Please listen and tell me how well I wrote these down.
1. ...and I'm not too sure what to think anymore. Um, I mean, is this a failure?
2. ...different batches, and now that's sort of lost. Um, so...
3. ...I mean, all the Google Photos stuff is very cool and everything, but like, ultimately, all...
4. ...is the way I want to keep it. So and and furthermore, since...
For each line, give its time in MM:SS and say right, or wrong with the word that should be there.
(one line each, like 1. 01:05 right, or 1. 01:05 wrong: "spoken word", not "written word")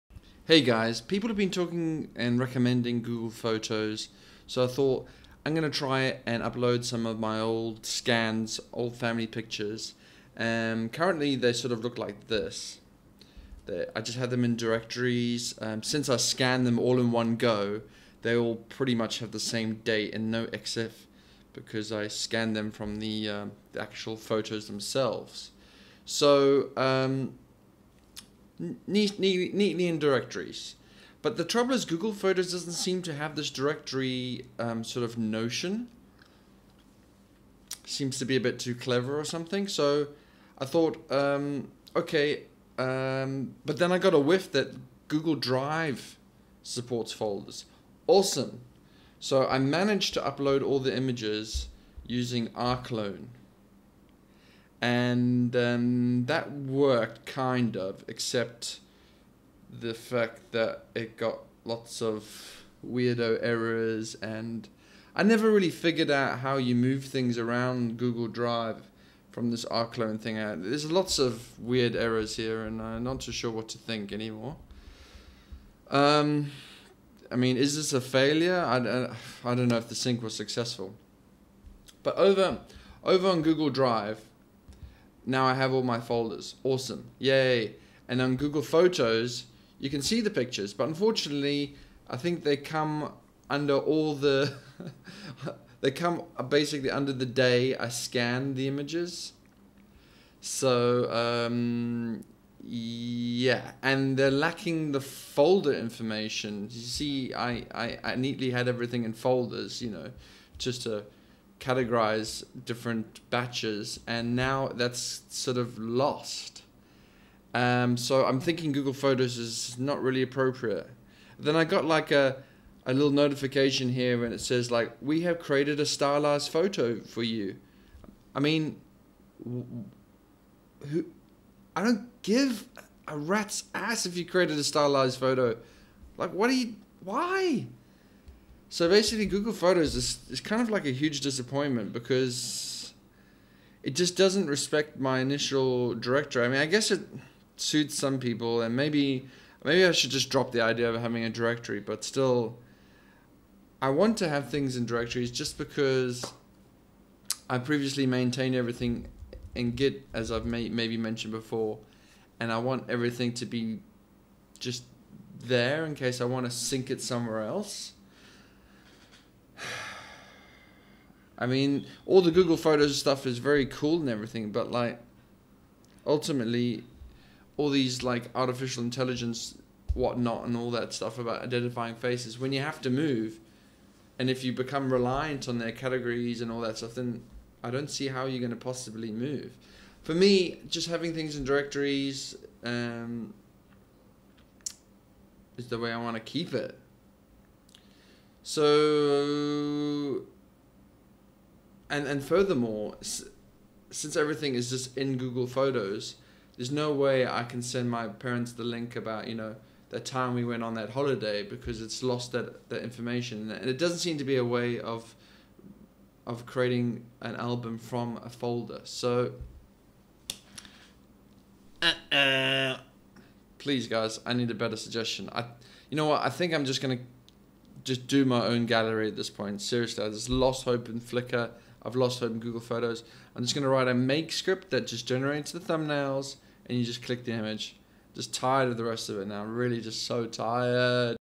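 1. 01:12 right
2. 01:52 right
3. 02:51 right
4. 03:15 right.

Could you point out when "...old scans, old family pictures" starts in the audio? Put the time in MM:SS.
00:07.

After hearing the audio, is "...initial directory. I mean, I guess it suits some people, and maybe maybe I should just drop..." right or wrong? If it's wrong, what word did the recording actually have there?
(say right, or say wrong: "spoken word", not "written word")
right.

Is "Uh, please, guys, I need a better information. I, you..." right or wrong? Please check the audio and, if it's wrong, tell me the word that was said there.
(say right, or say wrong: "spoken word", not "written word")
wrong: "suggestion", not "information".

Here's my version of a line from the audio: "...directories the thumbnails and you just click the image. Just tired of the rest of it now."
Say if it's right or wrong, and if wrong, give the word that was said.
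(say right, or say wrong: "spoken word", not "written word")
wrong: "generates", not "directories".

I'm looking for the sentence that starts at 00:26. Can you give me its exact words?
So, um, neat, neat, neatly in directories.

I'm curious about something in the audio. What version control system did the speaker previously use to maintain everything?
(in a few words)
Git.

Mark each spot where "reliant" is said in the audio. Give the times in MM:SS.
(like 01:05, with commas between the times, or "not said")
03:04.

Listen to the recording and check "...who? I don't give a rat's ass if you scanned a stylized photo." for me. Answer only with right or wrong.
wrong.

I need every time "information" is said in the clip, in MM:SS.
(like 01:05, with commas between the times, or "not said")
01:45, 03:32.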